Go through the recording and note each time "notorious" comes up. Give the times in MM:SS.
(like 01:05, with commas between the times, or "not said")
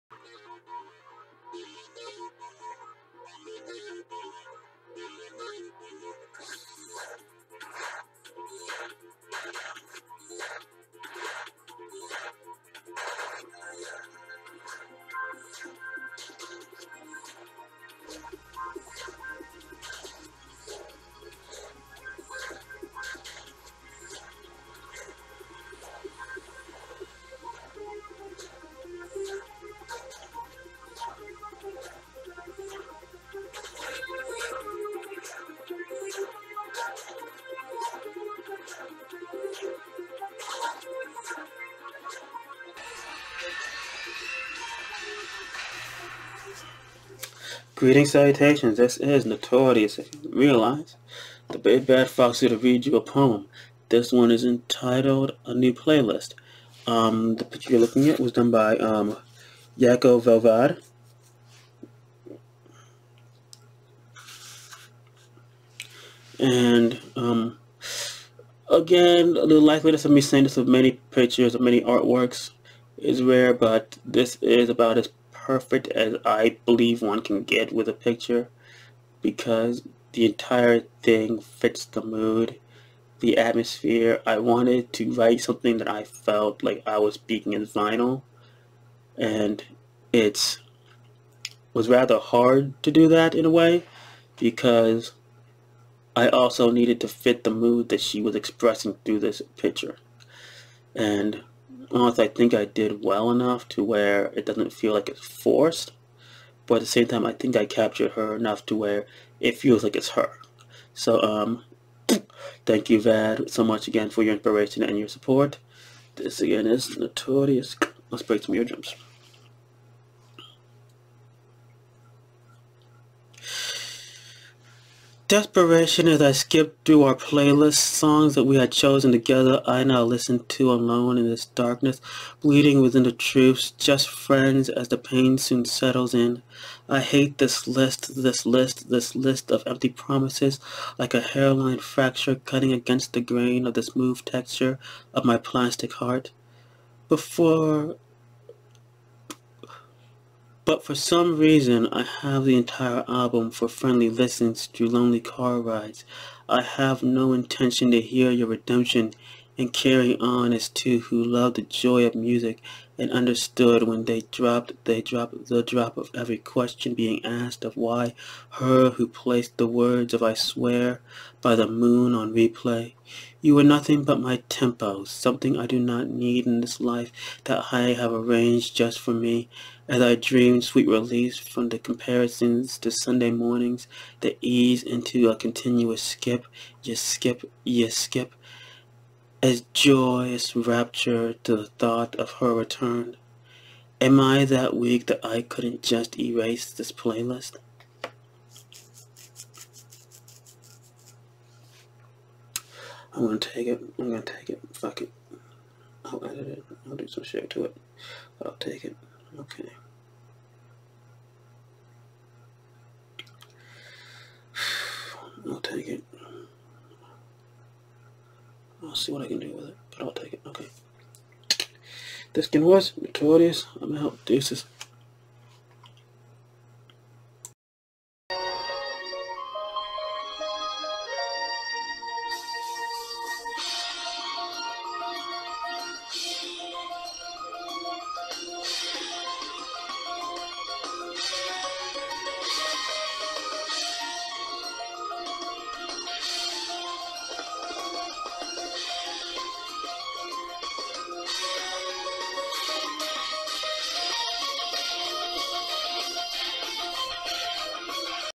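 00:49, 01:56, 03:42.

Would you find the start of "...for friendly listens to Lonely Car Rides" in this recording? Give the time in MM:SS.
02:33.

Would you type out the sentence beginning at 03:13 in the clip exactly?
Am I that weak that I couldn't just erase this playlist?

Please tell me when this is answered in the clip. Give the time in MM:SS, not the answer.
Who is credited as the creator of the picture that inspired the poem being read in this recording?
00:59.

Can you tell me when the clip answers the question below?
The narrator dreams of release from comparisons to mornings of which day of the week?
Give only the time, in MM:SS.
03:02.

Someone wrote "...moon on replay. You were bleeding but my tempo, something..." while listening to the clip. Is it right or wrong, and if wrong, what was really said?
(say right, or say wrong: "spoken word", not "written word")
wrong: "nothing", not "bleeding".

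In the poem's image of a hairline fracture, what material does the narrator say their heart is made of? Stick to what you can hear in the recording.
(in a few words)
plastic.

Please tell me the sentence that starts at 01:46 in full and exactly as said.
But at the same time, I think I captured her enough to where it feels like it's her.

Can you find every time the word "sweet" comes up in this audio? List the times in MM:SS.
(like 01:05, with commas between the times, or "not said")
03:00.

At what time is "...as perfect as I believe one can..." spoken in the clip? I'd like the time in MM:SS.
01:14.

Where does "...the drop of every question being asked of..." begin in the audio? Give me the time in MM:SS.
02:45.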